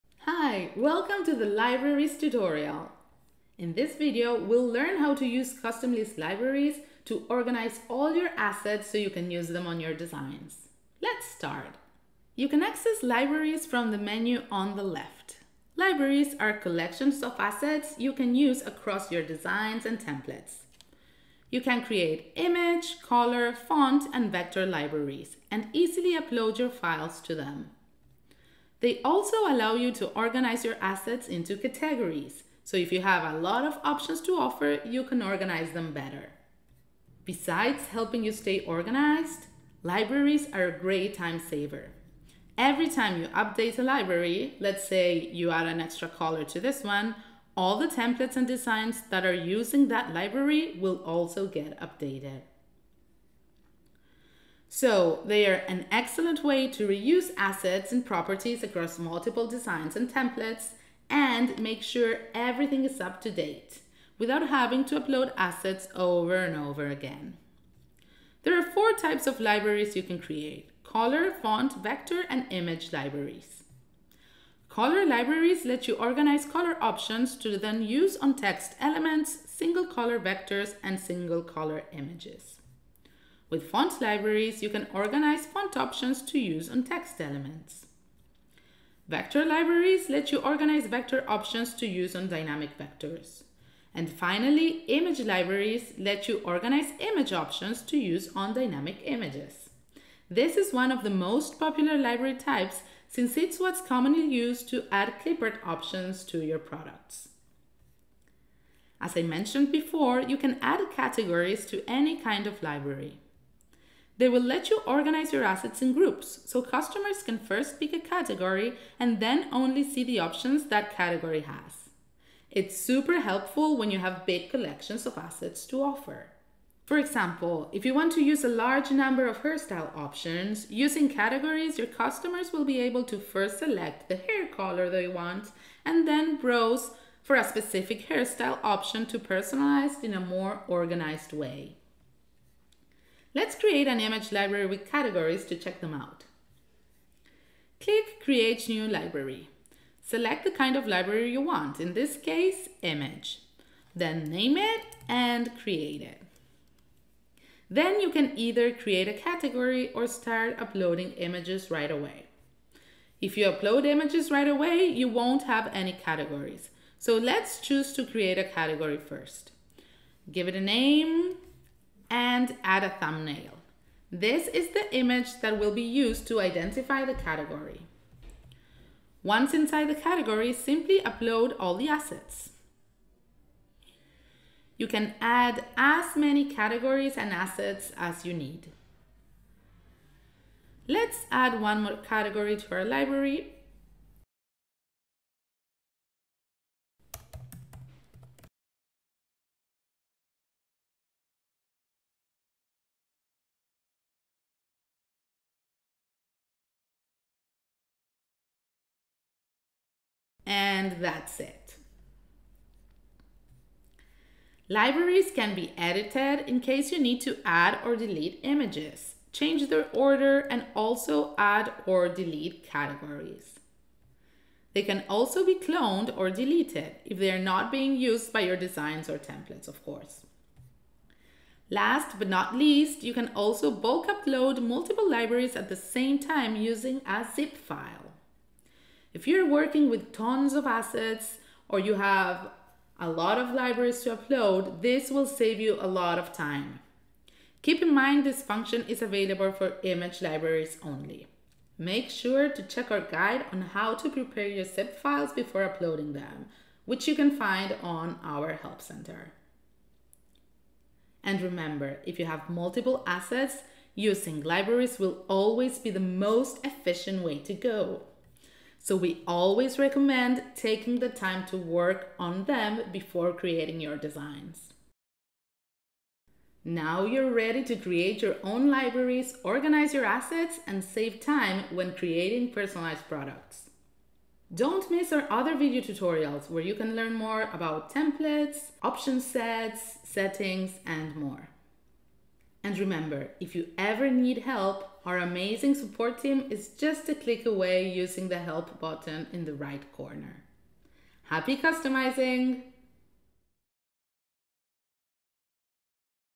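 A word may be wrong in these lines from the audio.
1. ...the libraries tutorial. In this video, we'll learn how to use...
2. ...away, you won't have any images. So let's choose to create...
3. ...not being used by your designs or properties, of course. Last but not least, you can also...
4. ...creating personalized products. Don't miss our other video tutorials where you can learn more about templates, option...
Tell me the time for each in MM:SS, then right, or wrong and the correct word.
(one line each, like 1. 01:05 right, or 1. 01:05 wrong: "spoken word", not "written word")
1. 00:01 right
2. 02:44 wrong: "categories", not "images"
3. 03:47 wrong: "templates", not "properties"
4. 04:41 right.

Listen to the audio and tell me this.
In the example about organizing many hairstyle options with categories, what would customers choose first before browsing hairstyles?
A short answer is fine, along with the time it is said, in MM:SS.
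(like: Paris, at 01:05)
Hair color, at 02:14.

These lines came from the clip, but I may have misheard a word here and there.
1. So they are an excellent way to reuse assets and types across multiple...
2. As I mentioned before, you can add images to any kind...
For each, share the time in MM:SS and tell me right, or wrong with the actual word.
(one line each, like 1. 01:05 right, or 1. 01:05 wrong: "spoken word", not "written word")
1. 00:54 wrong: "properties", not "types"
2. 01:49 wrong: "categories", not "images".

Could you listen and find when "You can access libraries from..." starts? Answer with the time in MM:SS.
00:12.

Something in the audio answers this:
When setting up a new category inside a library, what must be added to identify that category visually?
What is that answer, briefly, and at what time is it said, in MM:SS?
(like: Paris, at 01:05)
A thumbnail, at 02:52.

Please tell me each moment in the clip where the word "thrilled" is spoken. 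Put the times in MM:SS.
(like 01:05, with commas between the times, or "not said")
not said.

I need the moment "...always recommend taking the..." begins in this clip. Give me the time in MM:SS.
04:29.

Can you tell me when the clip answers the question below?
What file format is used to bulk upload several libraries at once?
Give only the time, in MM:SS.
03:57.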